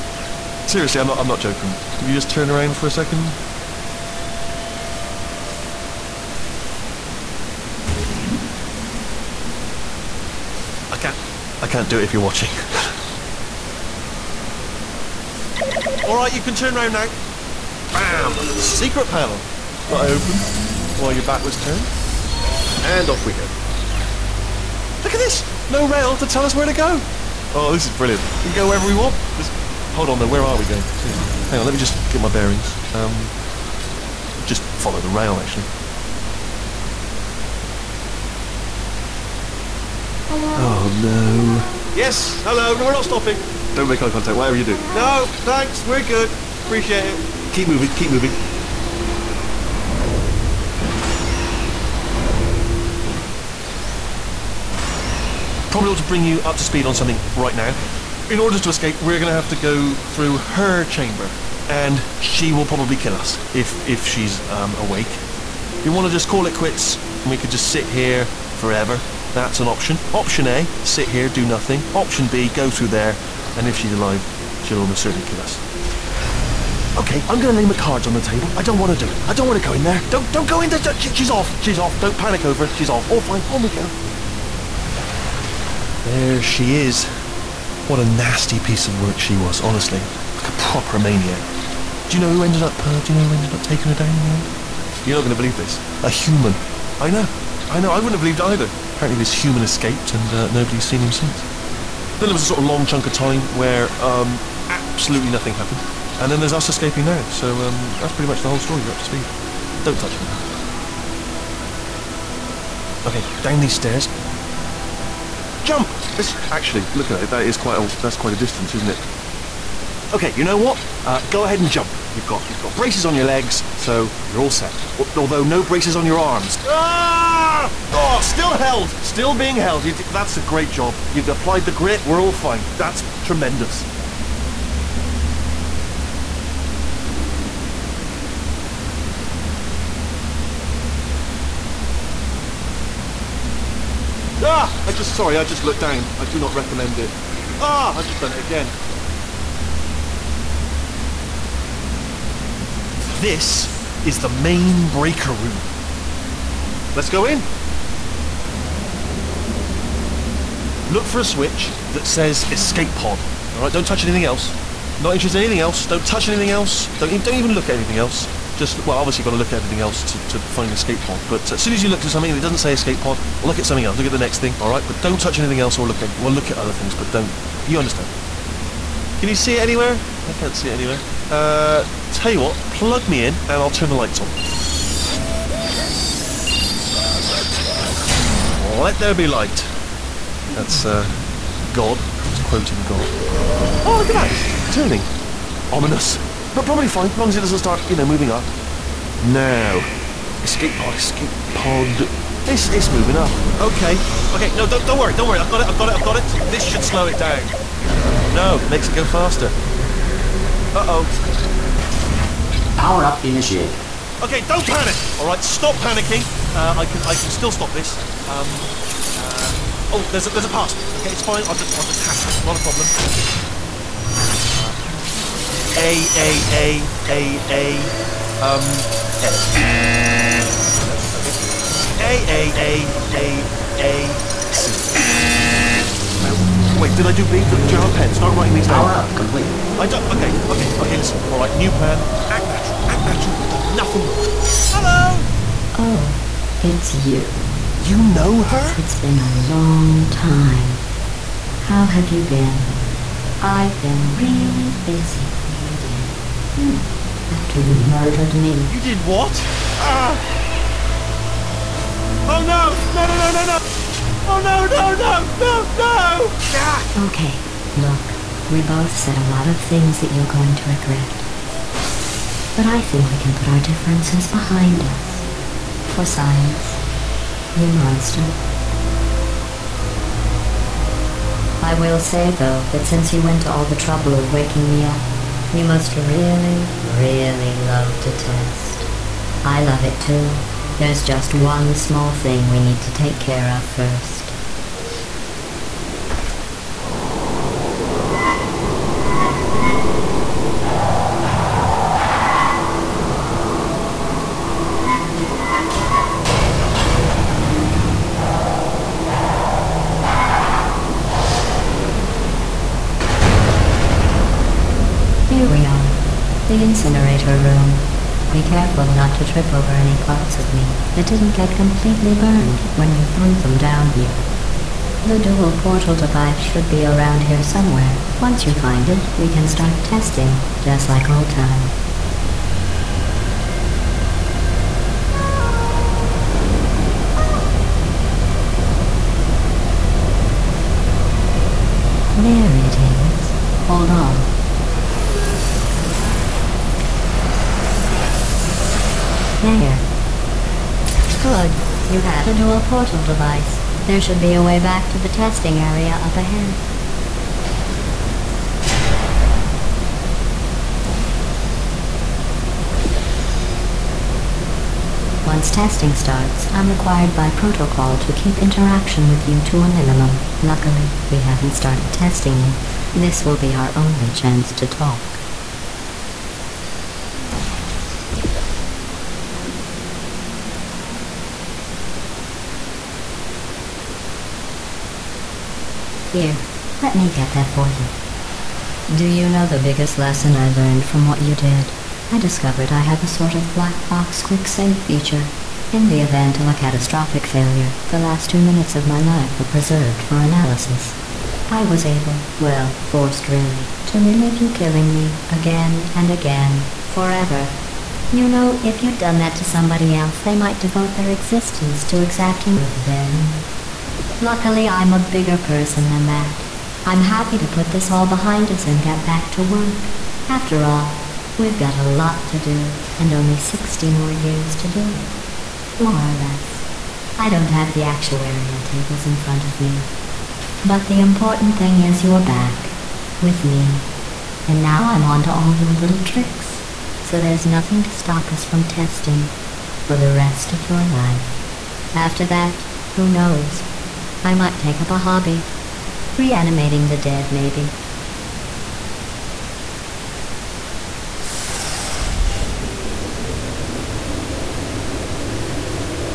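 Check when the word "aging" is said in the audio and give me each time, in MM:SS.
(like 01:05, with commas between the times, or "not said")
not said.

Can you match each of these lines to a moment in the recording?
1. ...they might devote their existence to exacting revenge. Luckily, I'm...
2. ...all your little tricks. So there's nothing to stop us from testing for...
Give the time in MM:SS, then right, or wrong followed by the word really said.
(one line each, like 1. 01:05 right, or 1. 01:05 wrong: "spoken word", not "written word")
1. 06:50 right
2. 07:15 right.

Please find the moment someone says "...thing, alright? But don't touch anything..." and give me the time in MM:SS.
02:54.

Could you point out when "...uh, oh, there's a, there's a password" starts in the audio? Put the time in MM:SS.
03:39.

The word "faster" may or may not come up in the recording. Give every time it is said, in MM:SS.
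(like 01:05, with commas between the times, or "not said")
03:29.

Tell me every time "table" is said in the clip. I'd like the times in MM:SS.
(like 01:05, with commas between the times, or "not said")
01:18, 07:08.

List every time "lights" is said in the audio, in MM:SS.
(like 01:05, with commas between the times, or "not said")
03:03, 03:09.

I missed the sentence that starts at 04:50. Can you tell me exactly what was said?
There's just one small thing we need to take care of first.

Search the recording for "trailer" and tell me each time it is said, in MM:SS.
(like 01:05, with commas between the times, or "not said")
not said.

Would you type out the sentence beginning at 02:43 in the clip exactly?
All right, don't touch anything else.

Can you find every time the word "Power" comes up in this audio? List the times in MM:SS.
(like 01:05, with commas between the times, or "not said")
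03:32, 03:58.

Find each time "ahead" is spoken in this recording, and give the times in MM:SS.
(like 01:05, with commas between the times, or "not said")
02:01, 05:56.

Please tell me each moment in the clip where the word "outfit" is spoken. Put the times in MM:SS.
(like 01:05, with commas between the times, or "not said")
not said.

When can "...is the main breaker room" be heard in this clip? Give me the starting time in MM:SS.
02:34.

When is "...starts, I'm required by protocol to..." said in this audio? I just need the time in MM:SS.
06:05.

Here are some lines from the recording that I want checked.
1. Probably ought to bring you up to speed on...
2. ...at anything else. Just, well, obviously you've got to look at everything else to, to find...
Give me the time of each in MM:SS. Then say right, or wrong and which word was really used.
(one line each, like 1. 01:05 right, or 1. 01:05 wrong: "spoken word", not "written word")
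1. 00:55 right
2. 02:47 right.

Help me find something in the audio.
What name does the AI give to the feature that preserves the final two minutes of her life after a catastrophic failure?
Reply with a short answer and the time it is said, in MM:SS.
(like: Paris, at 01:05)
Black box quick save, at 06:33.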